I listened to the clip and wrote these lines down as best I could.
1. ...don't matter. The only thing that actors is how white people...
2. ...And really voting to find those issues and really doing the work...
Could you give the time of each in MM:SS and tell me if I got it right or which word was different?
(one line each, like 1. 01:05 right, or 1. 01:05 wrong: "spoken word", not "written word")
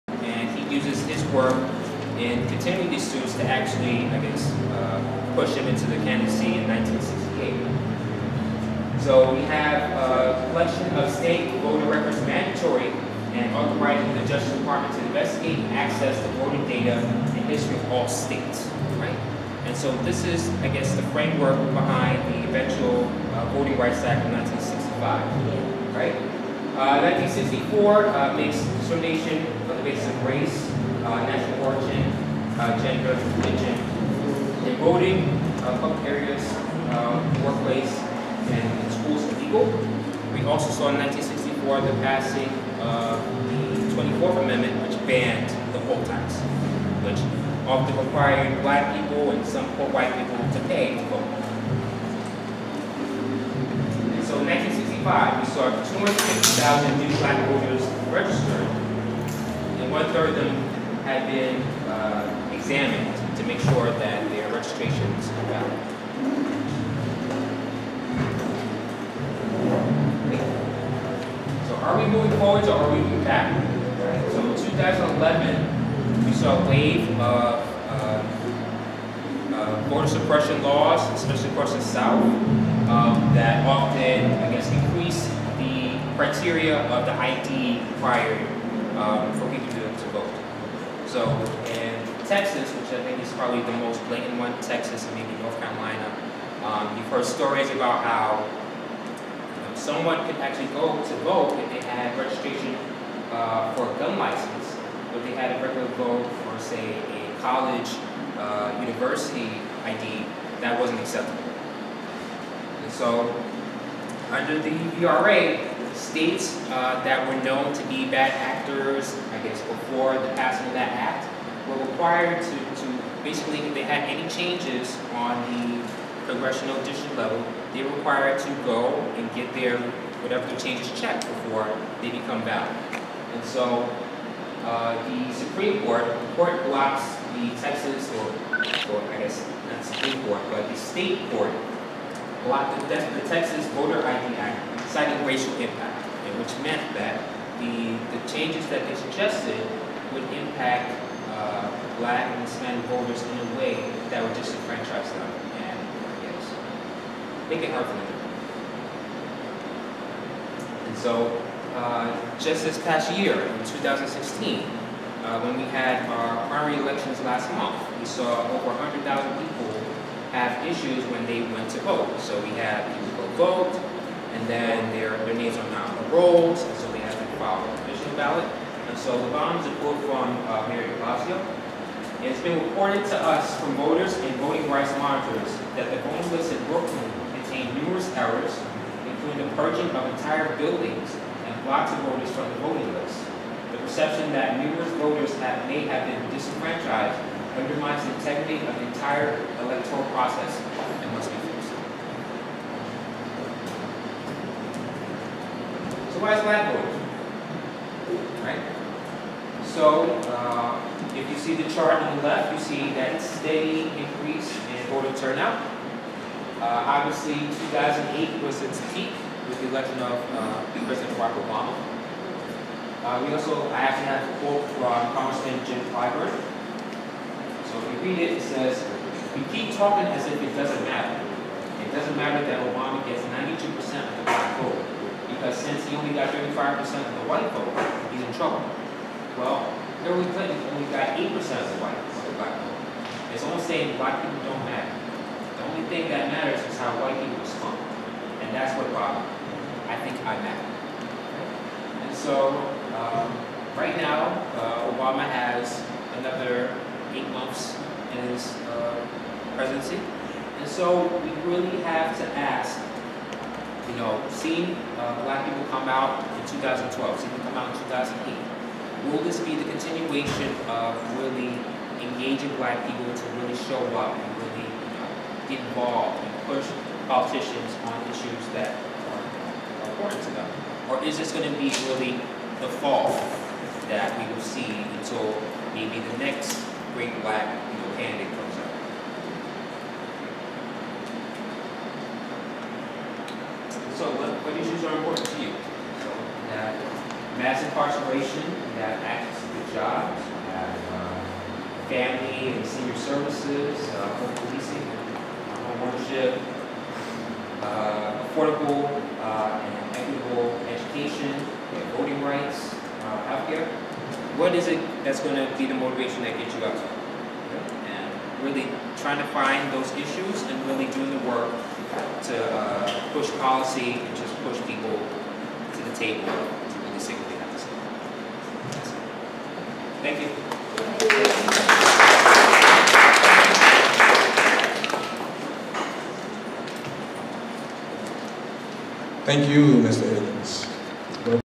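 1. 04:04 wrong: "matters", not "actors"
2. 05:16 wrong: "trying", not "voting".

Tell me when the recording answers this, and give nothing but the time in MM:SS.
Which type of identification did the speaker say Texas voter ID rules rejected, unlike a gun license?
01:48.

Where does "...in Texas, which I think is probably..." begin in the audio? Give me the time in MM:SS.
01:31.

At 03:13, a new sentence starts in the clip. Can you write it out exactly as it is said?
The perception that numerous voters have, may have been disenfranchised undermines the integrity of the entire electoral process and must be fixed.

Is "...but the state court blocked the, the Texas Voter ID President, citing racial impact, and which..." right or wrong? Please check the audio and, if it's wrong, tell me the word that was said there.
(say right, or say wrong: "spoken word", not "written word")
wrong: "Act", not "President".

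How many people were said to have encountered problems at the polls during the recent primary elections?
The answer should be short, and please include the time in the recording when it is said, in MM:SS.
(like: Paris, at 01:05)
over 100,000, at 02:48.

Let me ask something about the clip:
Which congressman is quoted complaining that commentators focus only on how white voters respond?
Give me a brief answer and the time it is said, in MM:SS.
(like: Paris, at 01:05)
Jim Clyburn, at 03:45.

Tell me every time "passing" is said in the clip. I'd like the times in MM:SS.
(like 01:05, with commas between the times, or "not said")
00:42, 02:00.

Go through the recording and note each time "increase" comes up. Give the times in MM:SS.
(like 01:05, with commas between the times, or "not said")
01:24, 03:33.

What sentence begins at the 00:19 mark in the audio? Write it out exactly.
And so this is, I guess, the framework behind the eventual uh, Voting Rights Act of 1965, right?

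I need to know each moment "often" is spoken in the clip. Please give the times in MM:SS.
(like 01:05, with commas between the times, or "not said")
00:47, 01:23.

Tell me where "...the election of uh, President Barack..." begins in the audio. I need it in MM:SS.
03:39.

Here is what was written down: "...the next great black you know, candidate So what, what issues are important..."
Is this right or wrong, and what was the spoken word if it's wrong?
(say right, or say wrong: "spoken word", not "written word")
right.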